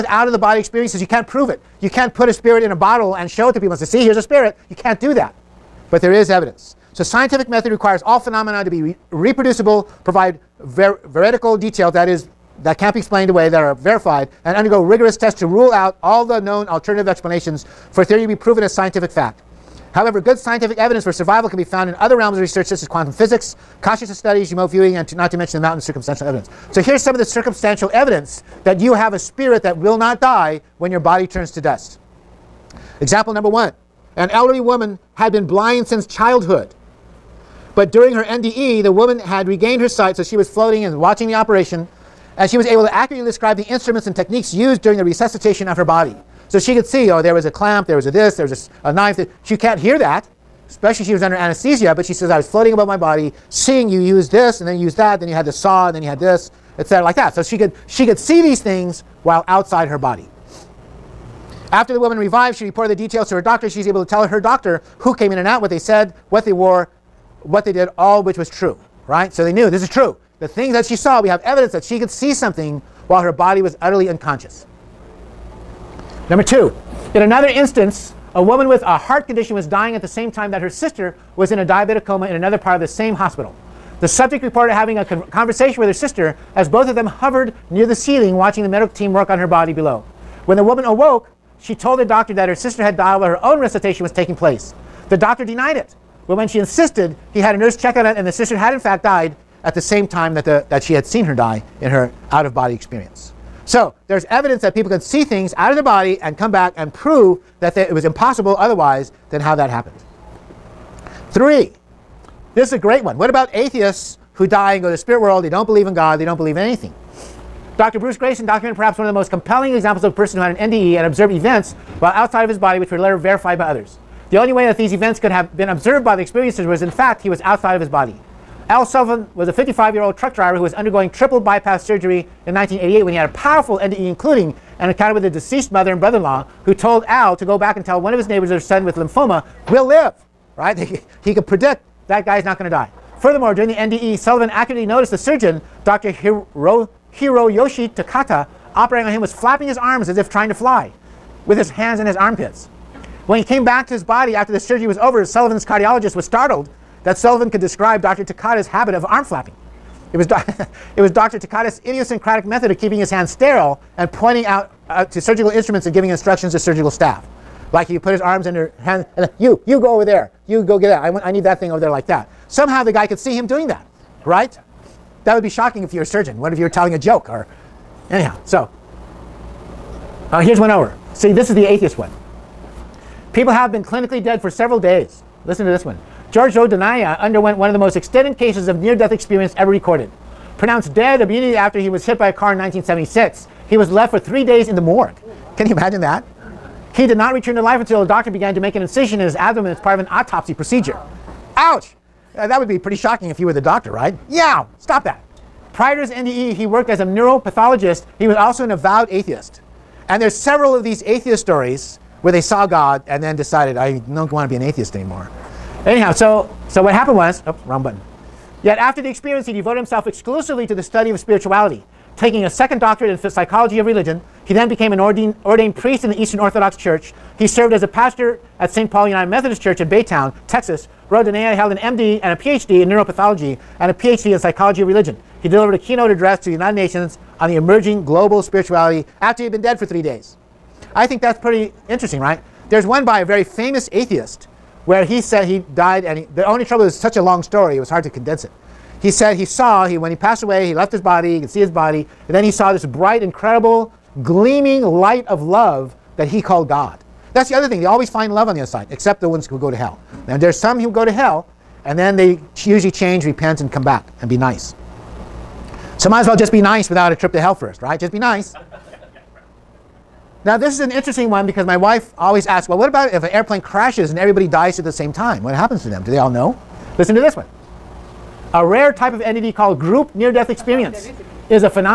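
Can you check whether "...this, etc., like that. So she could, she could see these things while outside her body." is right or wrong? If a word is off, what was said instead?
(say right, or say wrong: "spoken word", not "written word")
right.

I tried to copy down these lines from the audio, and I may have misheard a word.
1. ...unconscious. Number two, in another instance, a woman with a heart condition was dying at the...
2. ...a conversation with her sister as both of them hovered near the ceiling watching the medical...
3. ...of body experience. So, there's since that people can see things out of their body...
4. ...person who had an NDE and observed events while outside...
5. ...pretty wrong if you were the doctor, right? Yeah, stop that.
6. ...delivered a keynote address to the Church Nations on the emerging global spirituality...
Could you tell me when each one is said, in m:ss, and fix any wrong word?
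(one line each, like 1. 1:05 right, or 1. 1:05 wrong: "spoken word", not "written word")
1. 1:14 right
2. 1:24 right
3. 1:42 wrong: "evidence", not "since"
4. 2:00 right
5. 3:22 wrong: "shocking", not "wrong"
6. 3:55 wrong: "United", not "Church".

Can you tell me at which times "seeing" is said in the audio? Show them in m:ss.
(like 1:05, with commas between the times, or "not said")
0:53.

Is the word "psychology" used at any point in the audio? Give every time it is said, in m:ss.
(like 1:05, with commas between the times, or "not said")
3:43, 3:54.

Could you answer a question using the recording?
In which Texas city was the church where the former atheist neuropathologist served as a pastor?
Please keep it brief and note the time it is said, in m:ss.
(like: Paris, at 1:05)
Baytown, at 3:49.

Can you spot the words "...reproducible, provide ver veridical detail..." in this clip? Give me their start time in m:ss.
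0:09.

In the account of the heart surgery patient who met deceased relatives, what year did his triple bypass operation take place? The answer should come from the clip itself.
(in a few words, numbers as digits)
1988.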